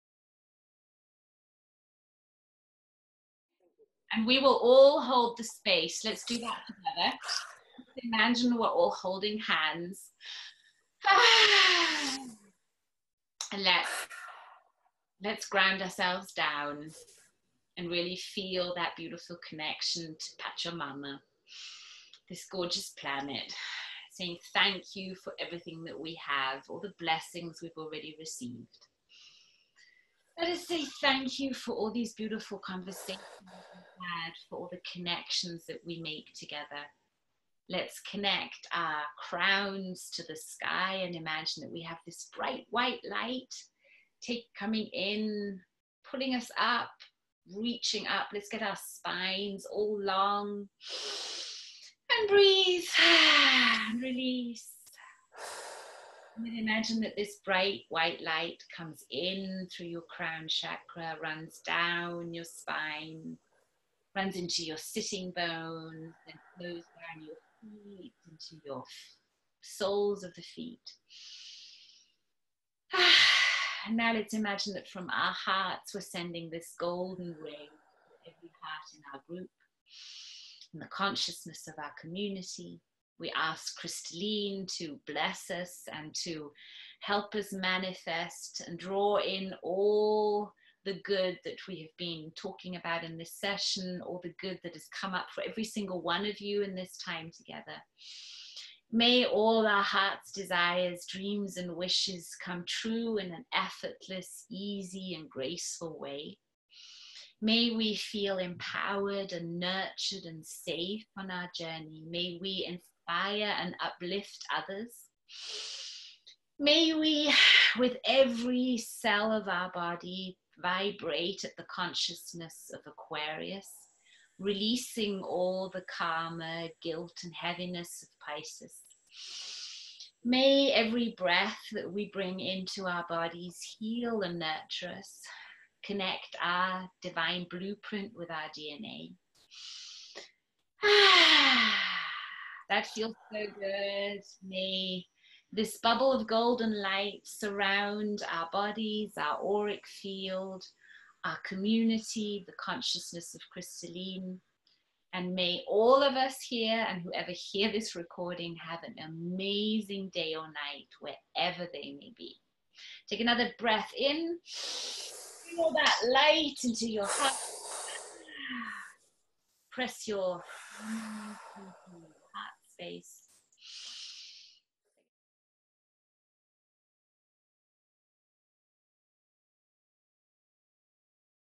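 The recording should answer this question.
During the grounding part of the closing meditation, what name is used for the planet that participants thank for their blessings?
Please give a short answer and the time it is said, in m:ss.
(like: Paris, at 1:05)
Pachamama, at 0:20.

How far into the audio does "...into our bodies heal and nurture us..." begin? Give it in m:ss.
2:12.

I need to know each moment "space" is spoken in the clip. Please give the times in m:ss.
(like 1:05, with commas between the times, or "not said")
0:05, 2:52.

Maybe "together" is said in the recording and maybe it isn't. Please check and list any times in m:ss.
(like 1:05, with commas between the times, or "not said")
0:06, 0:36, 1:37.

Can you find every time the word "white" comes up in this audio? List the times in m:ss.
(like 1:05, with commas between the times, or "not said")
0:42, 0:57.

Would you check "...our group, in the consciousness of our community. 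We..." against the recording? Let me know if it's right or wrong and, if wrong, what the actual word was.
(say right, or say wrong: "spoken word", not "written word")
right.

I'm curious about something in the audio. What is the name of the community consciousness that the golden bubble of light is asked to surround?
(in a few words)
Christallin.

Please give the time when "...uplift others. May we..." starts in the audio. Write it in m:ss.
1:53.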